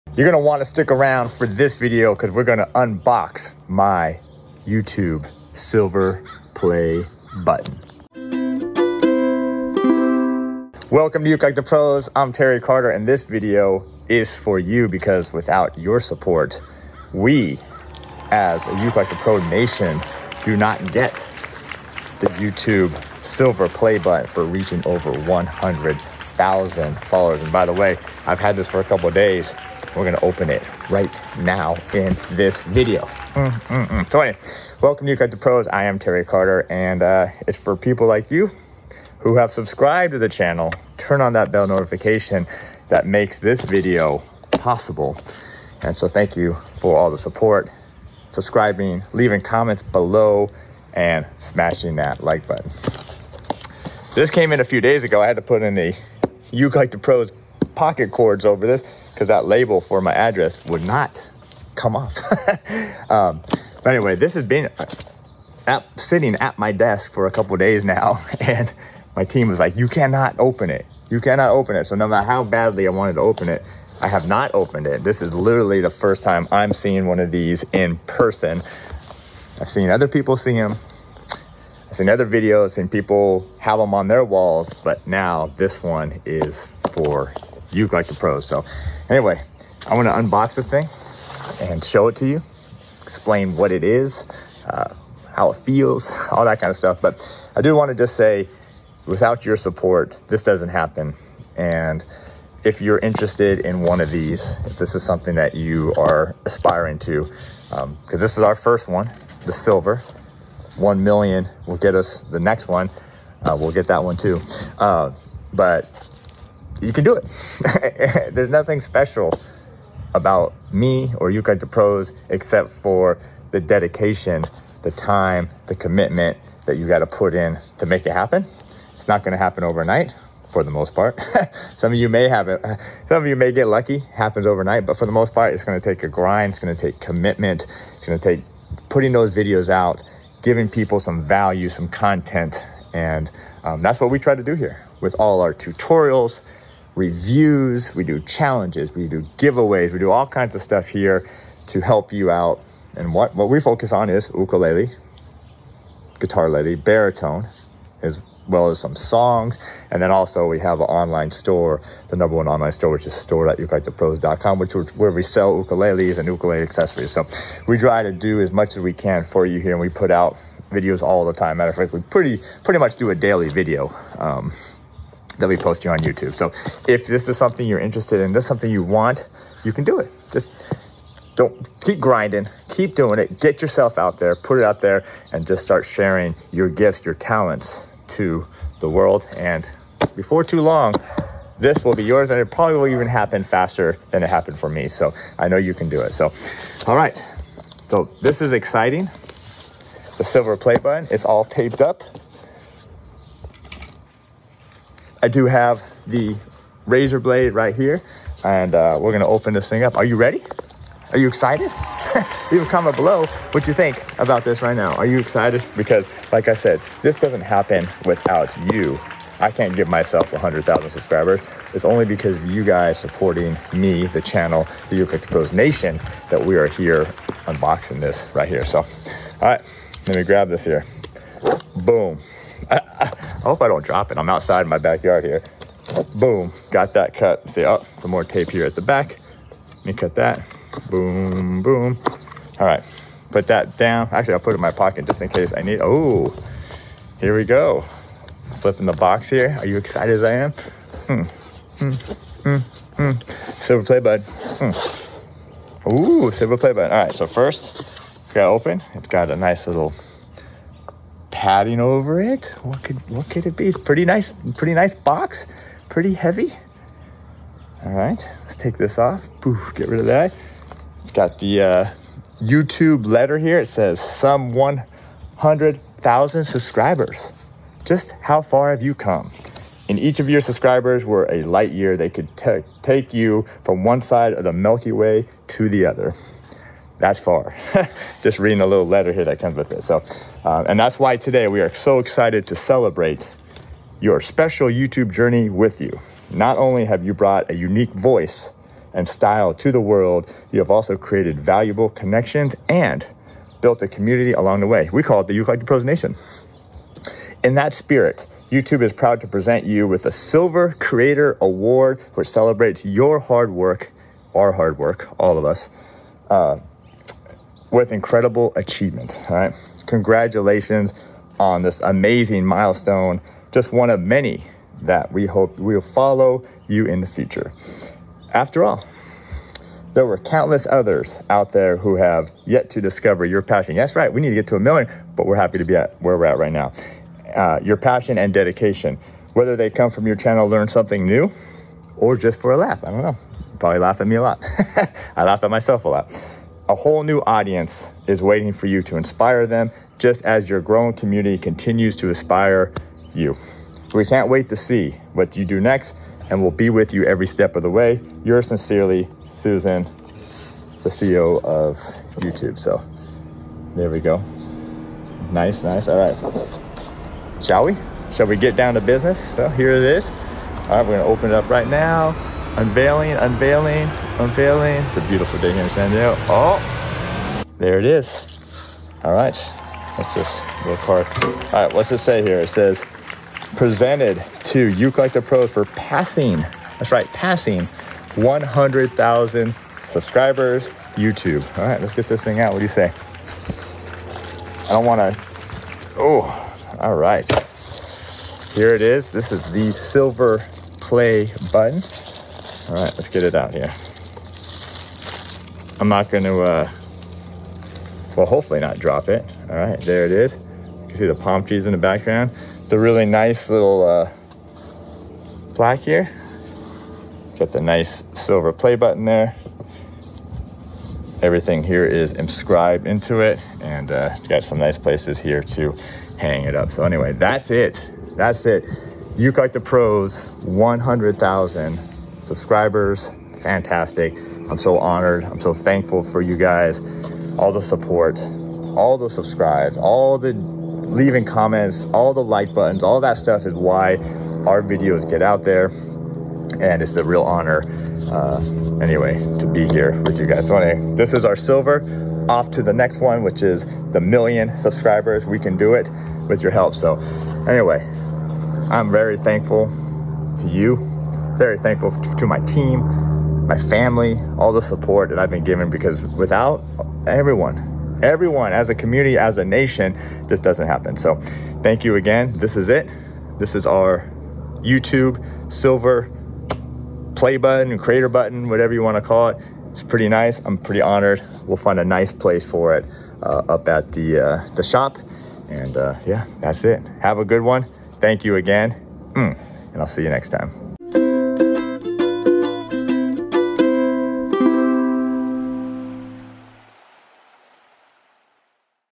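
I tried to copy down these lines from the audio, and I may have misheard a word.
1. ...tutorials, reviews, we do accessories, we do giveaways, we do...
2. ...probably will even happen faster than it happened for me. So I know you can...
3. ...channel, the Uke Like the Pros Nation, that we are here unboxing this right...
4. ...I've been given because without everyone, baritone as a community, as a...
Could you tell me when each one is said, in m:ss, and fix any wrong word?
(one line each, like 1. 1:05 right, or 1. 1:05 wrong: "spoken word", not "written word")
1. 2:25 wrong: "challenges", not "accessories"
2. 3:12 right
3. 3:44 right
4. 7:45 wrong: "everyone", not "baritone".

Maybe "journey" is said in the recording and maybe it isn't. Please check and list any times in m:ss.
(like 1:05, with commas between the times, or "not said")
4:55.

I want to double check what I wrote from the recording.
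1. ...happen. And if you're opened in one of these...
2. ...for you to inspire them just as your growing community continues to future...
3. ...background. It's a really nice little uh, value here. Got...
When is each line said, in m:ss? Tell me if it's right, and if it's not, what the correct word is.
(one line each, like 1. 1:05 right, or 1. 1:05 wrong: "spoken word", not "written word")
1. 1:40 wrong: "interested", not "opened"
2. 5:48 wrong: "inspire", not "future"
3. 6:51 wrong: "plaque", not "value".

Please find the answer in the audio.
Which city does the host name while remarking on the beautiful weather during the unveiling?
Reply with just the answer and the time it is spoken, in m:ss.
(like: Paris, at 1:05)
San Diego, at 6:15.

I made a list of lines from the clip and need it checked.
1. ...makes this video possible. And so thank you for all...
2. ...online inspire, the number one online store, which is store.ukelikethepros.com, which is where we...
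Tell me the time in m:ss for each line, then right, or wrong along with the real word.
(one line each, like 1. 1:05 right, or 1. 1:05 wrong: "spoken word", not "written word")
1. 0:43 right
2. 2:40 wrong: "store", not "inspire".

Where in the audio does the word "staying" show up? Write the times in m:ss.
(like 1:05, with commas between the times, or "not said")
not said.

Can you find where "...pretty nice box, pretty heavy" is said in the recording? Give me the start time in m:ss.
4:24.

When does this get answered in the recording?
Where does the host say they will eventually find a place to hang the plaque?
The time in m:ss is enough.
8:04.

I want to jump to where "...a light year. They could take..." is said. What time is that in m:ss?
4:41.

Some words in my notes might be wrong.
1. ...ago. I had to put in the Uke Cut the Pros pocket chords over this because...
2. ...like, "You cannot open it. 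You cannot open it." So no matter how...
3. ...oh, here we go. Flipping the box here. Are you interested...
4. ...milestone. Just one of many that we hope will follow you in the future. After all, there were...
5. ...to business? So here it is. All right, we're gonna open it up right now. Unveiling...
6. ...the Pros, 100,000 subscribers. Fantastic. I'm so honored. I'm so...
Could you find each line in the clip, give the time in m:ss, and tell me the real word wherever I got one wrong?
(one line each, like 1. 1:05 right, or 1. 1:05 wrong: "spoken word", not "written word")
1. 0:55 wrong: "Like", not "Cut"
2. 1:09 right
3. 4:05 wrong: "excited", not "interested"
4. 5:22 right
5. 6:08 right
6. 7:09 right.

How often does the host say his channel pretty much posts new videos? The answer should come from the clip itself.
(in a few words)
daily.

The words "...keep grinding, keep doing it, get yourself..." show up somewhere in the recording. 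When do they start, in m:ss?
3:01.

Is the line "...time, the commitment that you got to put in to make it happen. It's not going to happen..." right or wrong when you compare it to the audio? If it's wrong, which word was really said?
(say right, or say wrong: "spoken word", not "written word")
right.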